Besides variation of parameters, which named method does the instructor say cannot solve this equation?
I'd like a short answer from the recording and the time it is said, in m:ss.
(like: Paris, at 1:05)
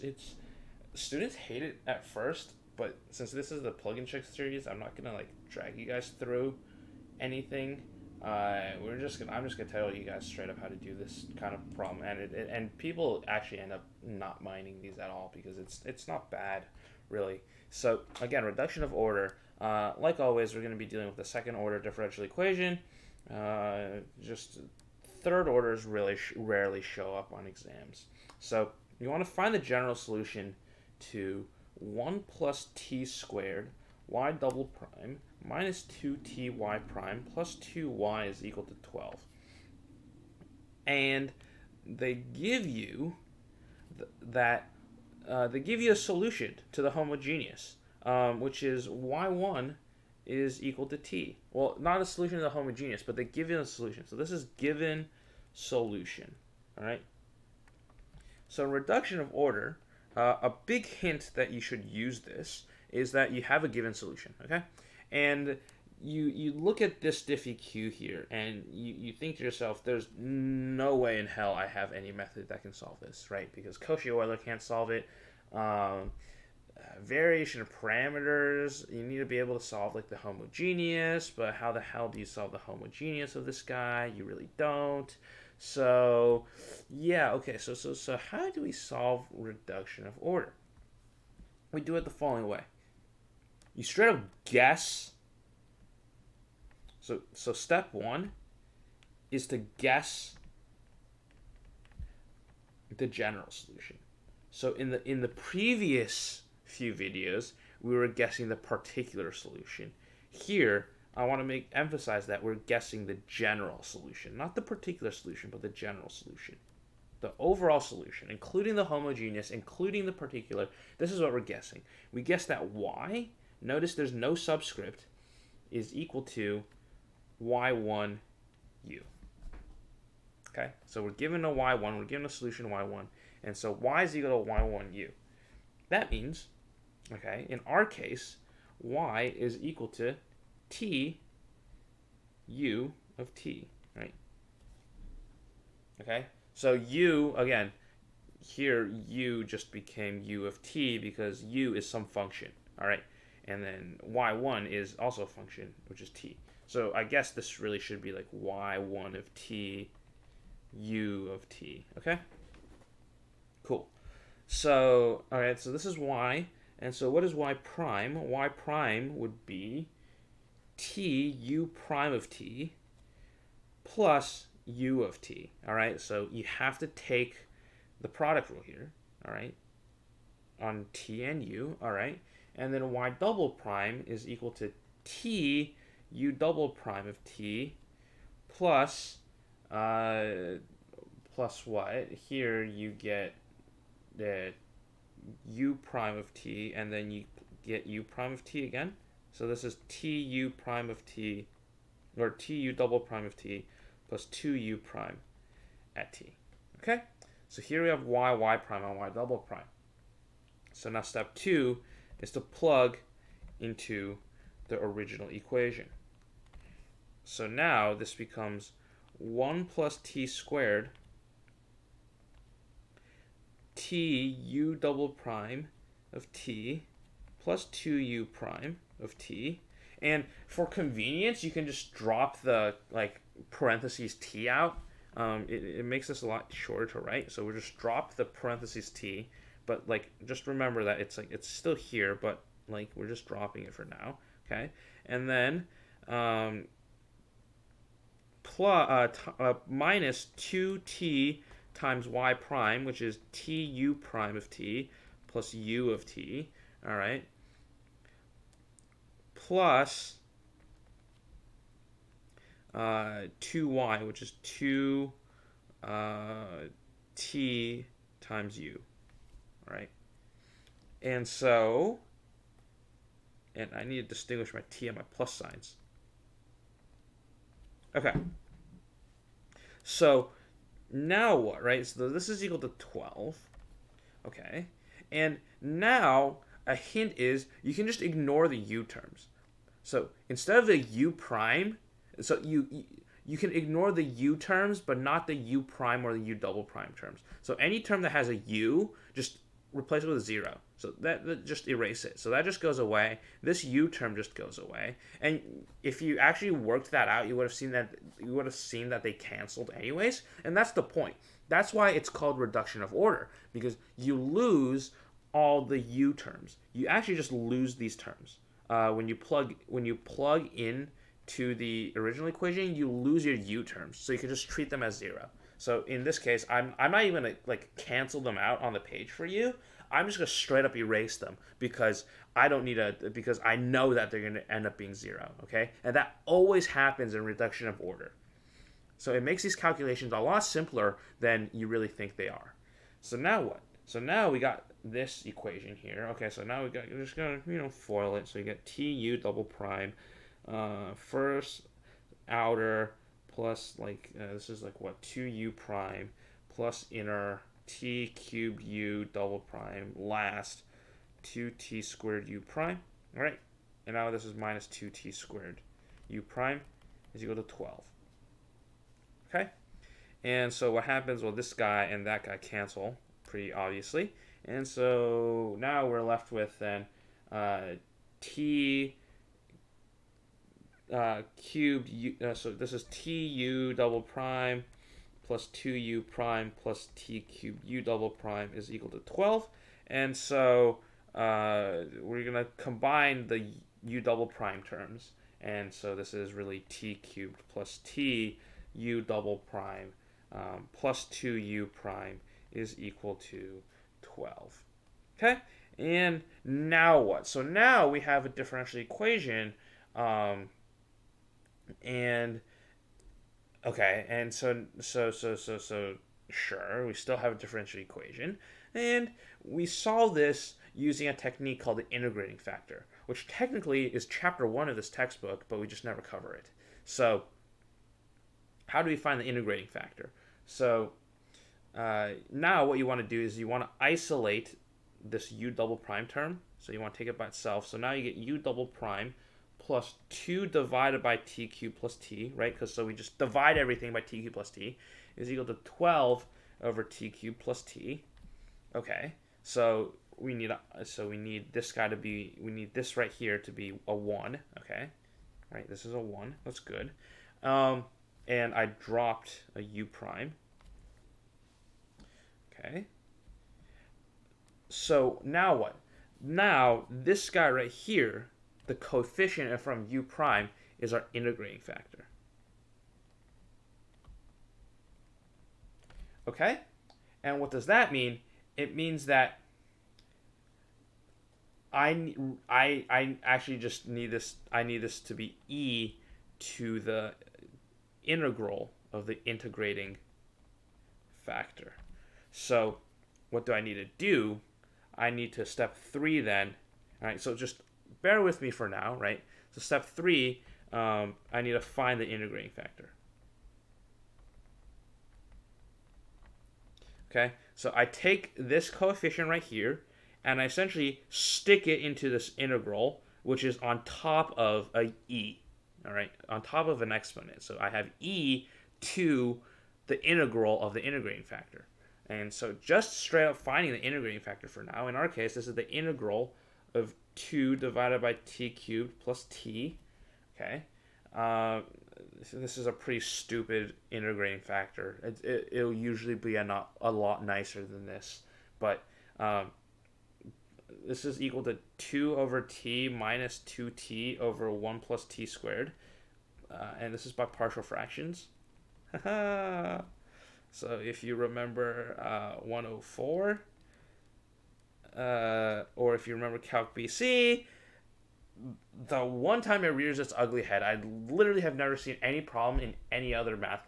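Cauchy-Euler, at 1:13.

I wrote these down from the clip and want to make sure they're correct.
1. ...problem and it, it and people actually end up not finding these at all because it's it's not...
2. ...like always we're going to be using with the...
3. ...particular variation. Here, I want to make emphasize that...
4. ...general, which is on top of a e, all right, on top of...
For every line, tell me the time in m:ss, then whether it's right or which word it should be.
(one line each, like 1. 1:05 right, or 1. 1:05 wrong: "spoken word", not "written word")
1. 0:11 wrong: "minding", not "finding"
2. 0:19 wrong: "dealing", not "using"
3. 1:48 wrong: "solution", not "variation"
4. 8:32 wrong: "integral", not "general".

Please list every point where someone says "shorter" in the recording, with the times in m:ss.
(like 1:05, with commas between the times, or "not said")
3:56.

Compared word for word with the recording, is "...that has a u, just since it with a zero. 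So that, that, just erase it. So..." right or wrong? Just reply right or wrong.
wrong.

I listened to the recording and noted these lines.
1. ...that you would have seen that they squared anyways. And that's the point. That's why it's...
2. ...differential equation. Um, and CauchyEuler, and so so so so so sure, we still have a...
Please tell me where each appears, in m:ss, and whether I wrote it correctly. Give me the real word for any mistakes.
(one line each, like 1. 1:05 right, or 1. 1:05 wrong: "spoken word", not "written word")
1. 5:07 wrong: "canceled", not "squared"
2. 6:48 wrong: "Okay", not "CauchyEuler".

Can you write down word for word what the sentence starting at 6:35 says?
And so this is really t cubed plus t u double prime um, plus 2u prime is equal to 12.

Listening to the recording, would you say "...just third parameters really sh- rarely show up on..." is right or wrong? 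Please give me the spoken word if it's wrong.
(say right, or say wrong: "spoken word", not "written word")
wrong: "orders", not "parameters".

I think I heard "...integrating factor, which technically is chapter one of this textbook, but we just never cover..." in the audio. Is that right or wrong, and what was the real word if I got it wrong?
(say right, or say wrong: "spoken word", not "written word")
right.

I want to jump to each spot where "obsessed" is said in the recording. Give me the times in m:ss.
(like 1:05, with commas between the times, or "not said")
not said.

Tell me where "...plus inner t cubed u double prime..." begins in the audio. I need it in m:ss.
5:56.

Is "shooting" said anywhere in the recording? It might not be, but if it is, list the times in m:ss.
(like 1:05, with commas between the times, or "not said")
not said.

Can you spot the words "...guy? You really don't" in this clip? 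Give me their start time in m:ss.
1:23.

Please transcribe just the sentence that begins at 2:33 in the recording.
And then y1 is also a function, which is t.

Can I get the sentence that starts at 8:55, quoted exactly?
It, it, will usually be a, not, a lot nicer than this.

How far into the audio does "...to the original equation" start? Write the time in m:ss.
5:21.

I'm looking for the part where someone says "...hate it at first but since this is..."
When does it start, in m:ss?
0:01.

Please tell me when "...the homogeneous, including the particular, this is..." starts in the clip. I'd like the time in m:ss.
1:58.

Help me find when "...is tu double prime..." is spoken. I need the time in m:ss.
6:22.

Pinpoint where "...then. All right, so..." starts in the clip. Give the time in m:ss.
8:16.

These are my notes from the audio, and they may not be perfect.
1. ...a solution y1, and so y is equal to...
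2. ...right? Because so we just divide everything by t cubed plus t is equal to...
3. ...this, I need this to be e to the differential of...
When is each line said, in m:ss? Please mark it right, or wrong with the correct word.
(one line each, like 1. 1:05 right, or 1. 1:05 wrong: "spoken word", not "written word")
1. 2:12 right
2. 7:22 right
3. 8:04 wrong: "integral", not "differential".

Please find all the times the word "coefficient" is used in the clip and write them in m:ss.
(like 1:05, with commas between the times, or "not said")
7:48, 8:28.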